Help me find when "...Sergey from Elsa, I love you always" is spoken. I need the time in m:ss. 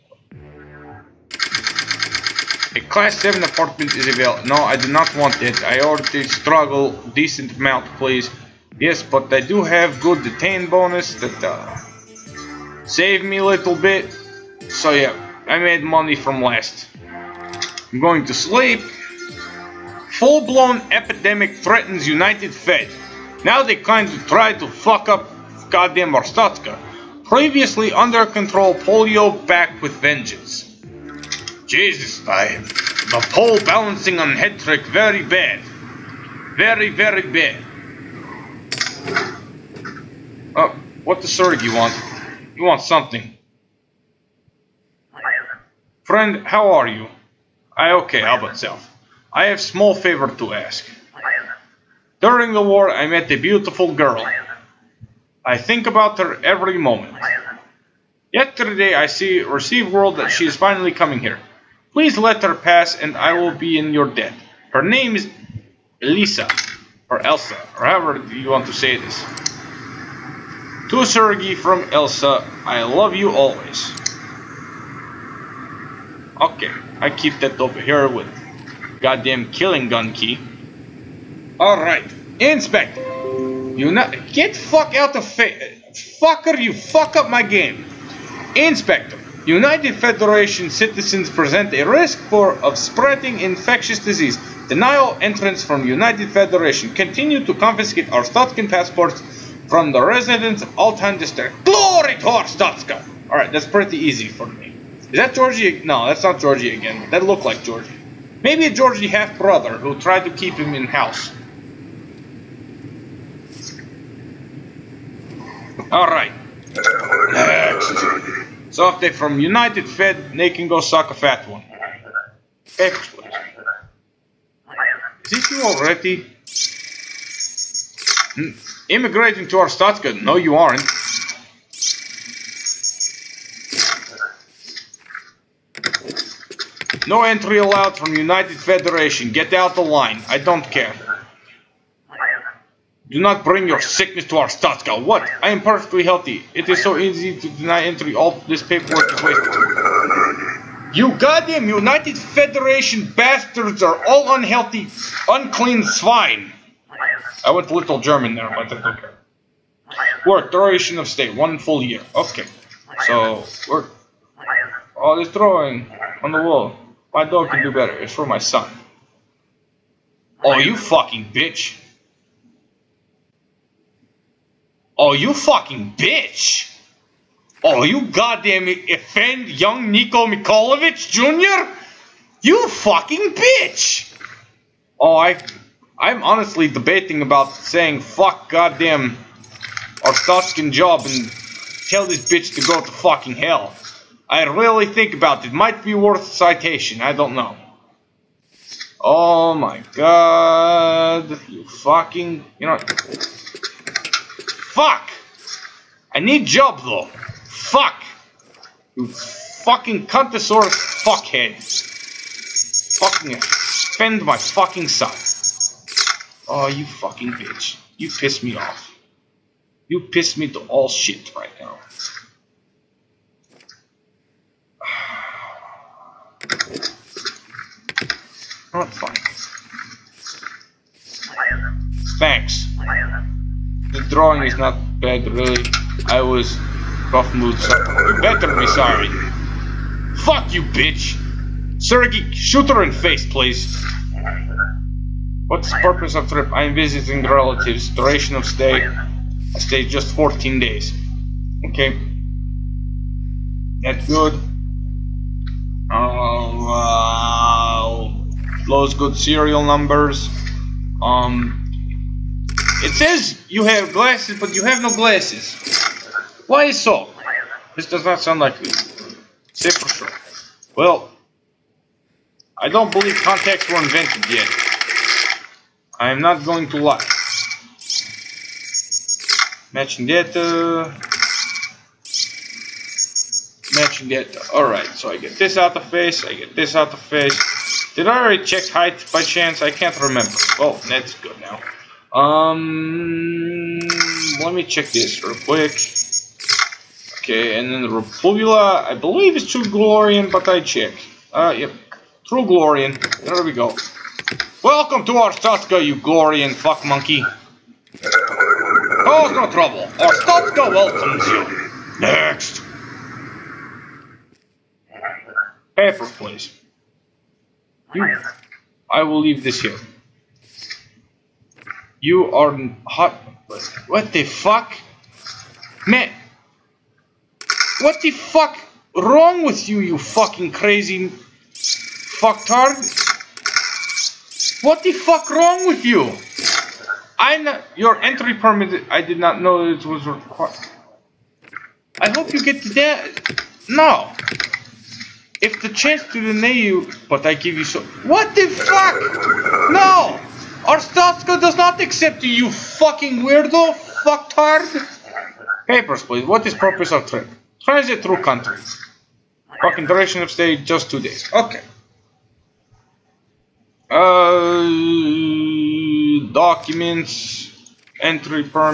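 1:11.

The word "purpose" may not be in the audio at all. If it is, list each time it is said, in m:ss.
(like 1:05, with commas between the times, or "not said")
4:05, 5:56.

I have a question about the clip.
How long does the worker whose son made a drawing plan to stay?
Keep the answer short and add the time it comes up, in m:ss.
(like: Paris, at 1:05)
One full year, at 2:41.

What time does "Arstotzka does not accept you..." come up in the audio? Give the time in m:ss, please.
5:50.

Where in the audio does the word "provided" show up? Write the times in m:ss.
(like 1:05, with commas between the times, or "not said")
not said.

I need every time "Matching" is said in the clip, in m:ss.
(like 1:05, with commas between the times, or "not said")
4:39, 4:43.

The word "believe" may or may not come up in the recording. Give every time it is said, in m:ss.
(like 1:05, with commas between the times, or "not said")
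4:32, 4:58.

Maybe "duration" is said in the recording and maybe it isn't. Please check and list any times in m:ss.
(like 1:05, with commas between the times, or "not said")
2:40, 4:07, 5:59.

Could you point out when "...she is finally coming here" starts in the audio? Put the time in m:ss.
1:00.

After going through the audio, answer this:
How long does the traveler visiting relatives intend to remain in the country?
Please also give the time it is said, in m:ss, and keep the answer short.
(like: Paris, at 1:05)
14 days, at 4:10.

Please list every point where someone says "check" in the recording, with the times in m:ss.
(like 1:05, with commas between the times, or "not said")
4:48, 4:54, 5:00.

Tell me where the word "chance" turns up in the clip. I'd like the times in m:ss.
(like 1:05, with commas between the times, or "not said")
4:49, 5:45.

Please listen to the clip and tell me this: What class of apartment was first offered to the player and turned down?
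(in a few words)
7.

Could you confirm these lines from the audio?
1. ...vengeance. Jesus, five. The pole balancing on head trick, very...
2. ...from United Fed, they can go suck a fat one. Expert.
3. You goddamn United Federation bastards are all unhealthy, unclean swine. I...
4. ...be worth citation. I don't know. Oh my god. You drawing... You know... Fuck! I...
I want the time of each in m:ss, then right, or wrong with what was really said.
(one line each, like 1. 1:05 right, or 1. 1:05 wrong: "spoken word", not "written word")
1. 0:29 right
2. 1:59 right
3. 2:30 right
4. 3:15 wrong: "fucking", not "drawing".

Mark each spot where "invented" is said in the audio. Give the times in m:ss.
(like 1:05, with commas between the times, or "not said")
4:33.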